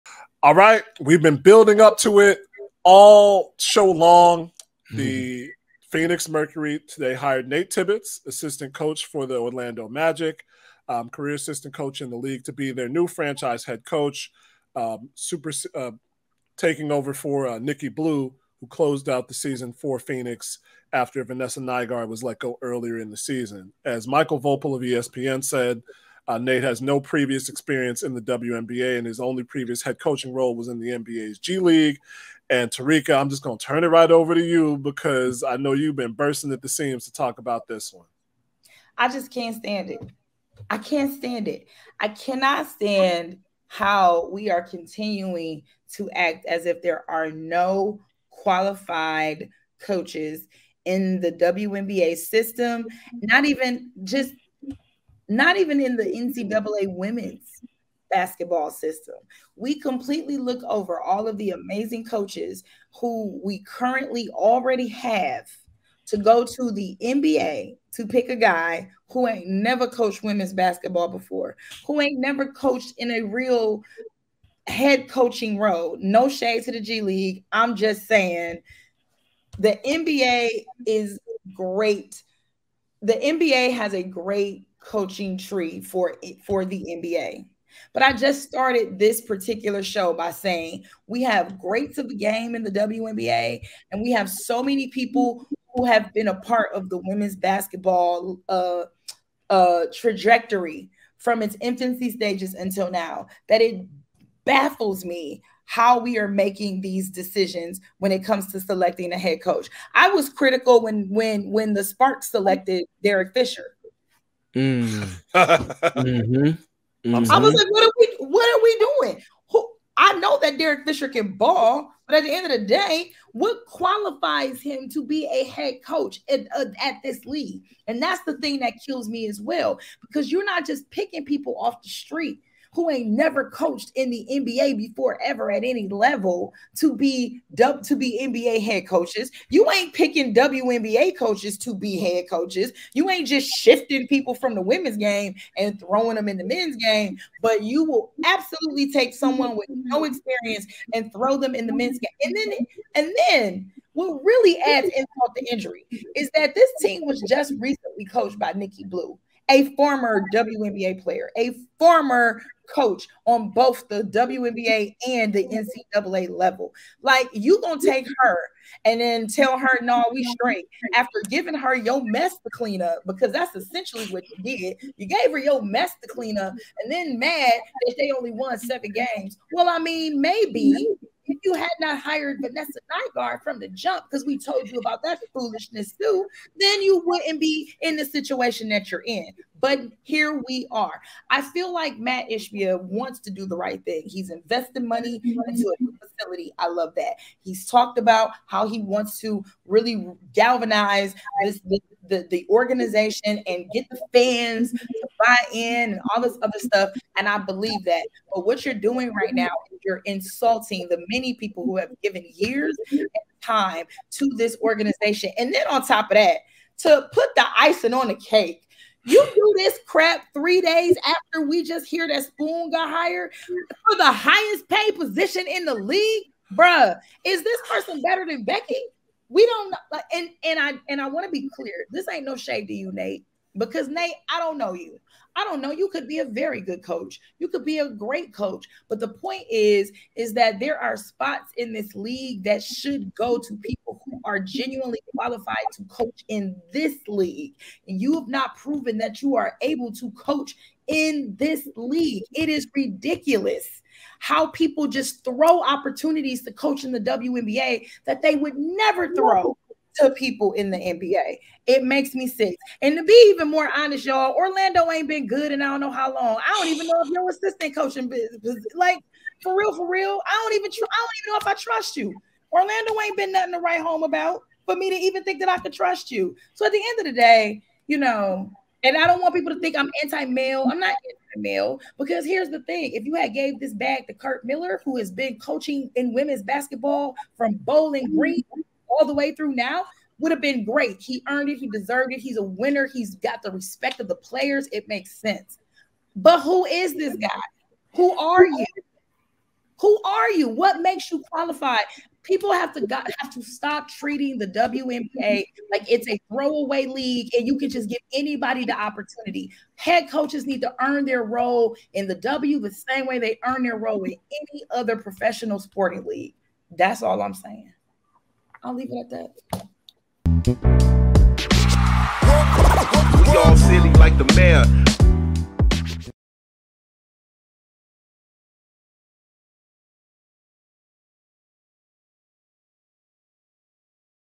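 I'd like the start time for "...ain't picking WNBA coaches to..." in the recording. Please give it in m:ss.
2:19.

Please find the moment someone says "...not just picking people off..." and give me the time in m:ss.
2:10.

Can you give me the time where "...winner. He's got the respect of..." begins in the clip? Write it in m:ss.
4:52.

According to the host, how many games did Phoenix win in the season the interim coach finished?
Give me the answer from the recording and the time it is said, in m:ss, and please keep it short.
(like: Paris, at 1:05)
7, at 2:58.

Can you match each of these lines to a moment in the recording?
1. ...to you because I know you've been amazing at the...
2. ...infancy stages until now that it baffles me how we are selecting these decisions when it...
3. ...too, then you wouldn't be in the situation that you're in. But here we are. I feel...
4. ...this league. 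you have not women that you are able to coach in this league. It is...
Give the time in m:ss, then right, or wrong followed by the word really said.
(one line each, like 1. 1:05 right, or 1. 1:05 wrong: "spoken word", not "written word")
1. 0:34 wrong: "bursting", not "amazing"
2. 1:41 wrong: "making", not "selecting"
3. 3:05 right
4. 4:06 wrong: "proven", not "women".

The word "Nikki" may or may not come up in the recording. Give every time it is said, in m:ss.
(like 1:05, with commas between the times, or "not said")
0:17, 2:38.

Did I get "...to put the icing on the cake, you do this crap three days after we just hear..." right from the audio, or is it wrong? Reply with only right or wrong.
right.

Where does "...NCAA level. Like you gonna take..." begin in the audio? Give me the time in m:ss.
2:45.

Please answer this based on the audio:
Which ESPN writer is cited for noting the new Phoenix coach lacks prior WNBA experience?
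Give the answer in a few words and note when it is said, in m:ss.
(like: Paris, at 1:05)
Michael Voepel, at 0:24.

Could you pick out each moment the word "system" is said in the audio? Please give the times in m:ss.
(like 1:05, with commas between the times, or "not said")
0:52, 0:58.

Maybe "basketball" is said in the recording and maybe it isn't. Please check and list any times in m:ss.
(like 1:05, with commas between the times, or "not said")
0:58, 1:10, 1:37, 4:46.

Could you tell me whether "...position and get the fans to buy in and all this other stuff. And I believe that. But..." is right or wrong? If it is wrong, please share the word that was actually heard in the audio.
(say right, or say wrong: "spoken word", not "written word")
wrong: "organization", not "position".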